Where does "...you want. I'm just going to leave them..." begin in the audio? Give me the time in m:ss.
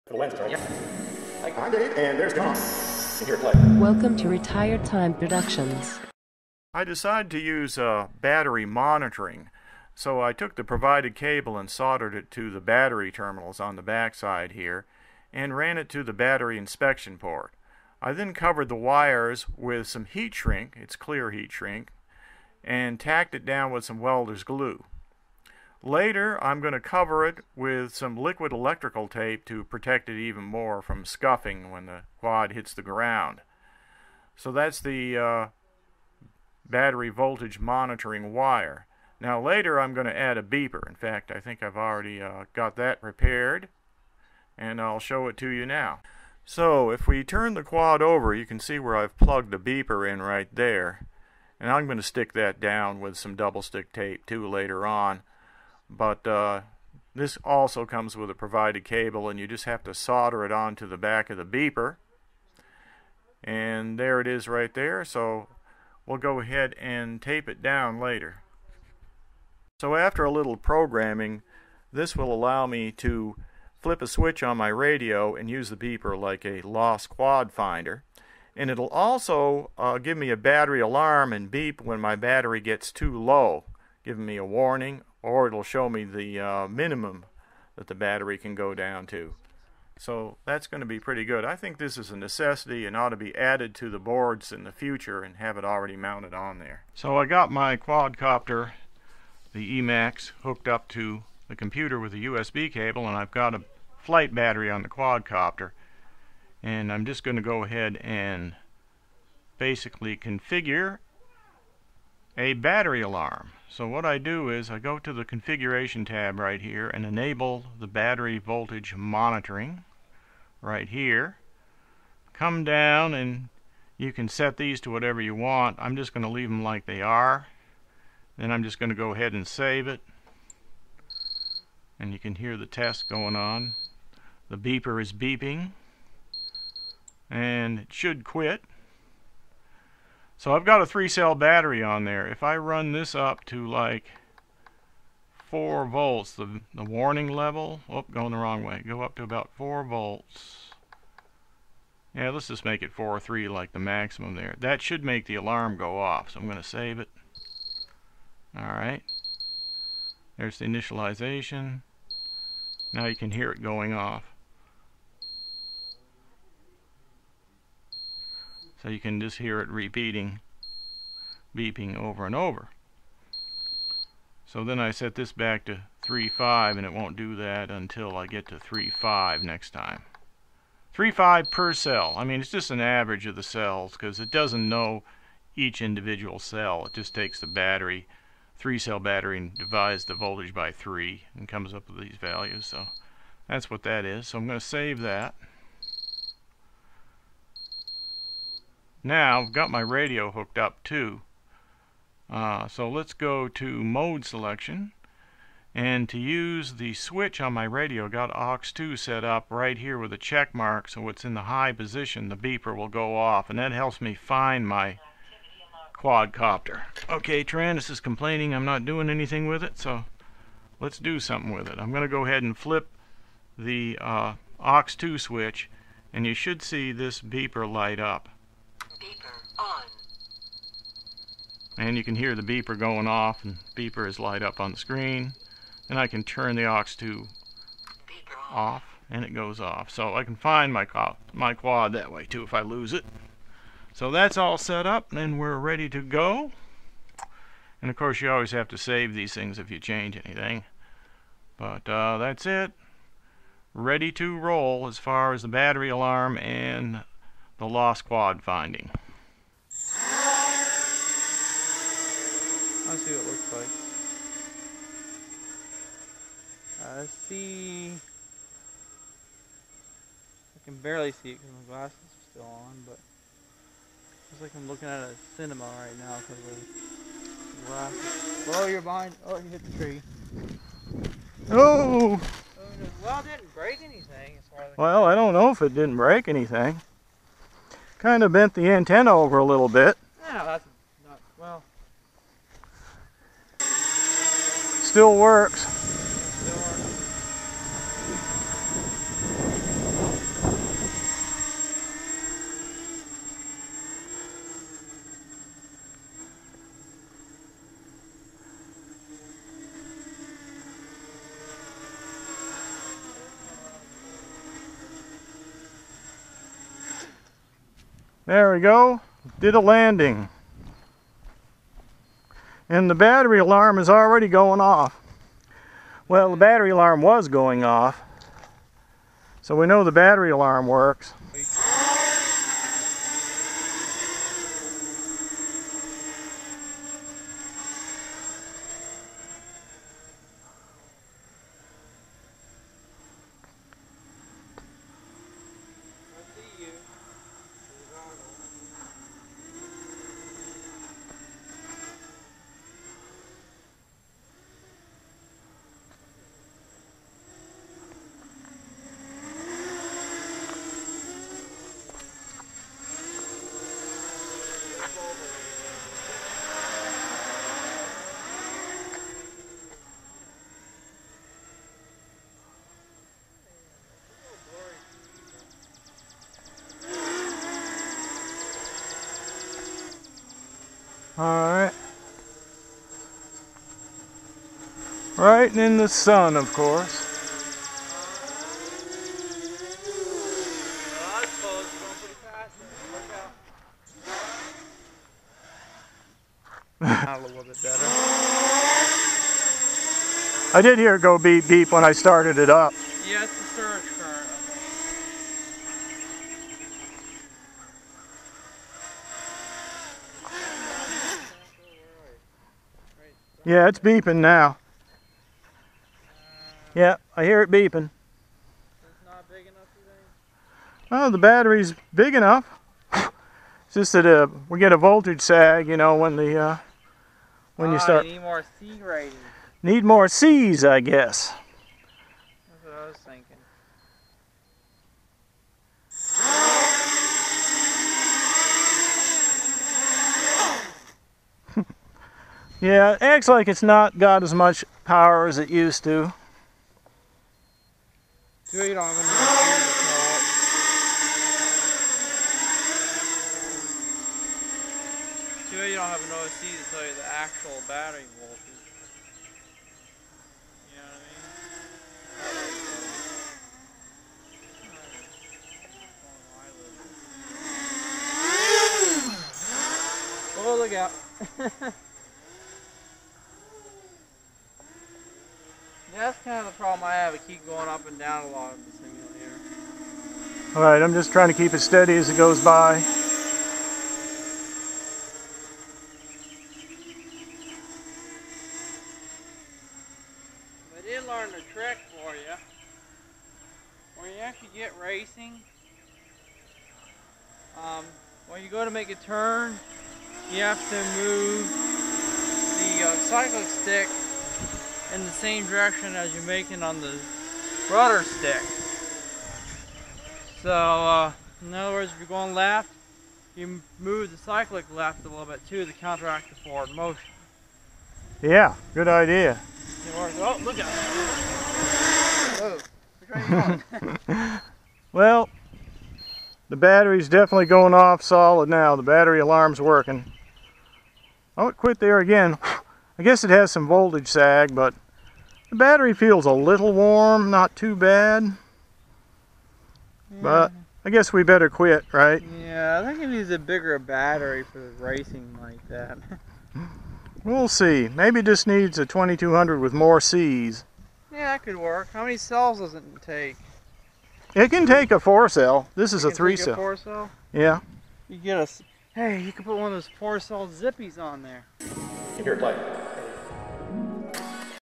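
2:05.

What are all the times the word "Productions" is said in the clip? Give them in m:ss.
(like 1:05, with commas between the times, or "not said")
0:05.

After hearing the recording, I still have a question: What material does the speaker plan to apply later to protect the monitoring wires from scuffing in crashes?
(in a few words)
liquid electrical tape.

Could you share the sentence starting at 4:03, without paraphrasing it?
So that's all set up, and we're ready to go.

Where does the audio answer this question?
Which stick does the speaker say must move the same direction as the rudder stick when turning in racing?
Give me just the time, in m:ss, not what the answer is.
8:22.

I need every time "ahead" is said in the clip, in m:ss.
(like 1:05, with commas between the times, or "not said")
1:06, 1:47, 2:09, 3:42.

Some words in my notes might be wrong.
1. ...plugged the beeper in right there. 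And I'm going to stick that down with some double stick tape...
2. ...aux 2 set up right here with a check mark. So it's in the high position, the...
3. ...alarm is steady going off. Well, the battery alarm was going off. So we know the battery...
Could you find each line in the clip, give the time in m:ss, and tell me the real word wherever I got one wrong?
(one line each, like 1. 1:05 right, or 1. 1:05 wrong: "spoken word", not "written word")
1. 0:49 right
2. 3:28 right
3. 5:23 wrong: "already", not "steady".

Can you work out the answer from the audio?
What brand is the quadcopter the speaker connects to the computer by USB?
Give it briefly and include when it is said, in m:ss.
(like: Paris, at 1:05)
Emax, at 1:39.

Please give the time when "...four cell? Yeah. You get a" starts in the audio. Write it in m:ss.
9:16.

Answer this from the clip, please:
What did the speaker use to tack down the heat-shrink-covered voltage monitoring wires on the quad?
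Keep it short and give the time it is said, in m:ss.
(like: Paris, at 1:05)
welder's glue, at 0:23.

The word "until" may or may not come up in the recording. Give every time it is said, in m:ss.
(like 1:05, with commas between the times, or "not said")
2:57.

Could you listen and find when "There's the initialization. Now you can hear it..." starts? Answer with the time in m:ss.
2:40.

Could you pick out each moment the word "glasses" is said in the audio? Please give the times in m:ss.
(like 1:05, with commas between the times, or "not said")
4:31, 4:37.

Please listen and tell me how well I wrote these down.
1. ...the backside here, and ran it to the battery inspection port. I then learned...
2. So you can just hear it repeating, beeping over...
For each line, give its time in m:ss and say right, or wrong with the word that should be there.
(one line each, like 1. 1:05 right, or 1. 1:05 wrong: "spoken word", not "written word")
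1. 0:13 wrong: "covered", not "learned"
2. 2:48 right.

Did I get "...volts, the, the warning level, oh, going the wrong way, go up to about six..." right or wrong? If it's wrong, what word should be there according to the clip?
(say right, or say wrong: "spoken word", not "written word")
wrong: "four", not "six".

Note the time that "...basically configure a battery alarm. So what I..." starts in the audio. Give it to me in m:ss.
1:49.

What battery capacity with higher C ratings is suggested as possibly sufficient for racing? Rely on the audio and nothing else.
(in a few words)
2200.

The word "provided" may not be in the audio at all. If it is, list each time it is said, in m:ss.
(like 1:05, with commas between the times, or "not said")
0:10, 0:58.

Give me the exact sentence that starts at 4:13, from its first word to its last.
Ready to roll as far as the battery alarm and the lost quad finding.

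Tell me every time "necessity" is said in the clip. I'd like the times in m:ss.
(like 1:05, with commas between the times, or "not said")
1:32.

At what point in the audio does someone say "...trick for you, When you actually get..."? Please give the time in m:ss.
8:11.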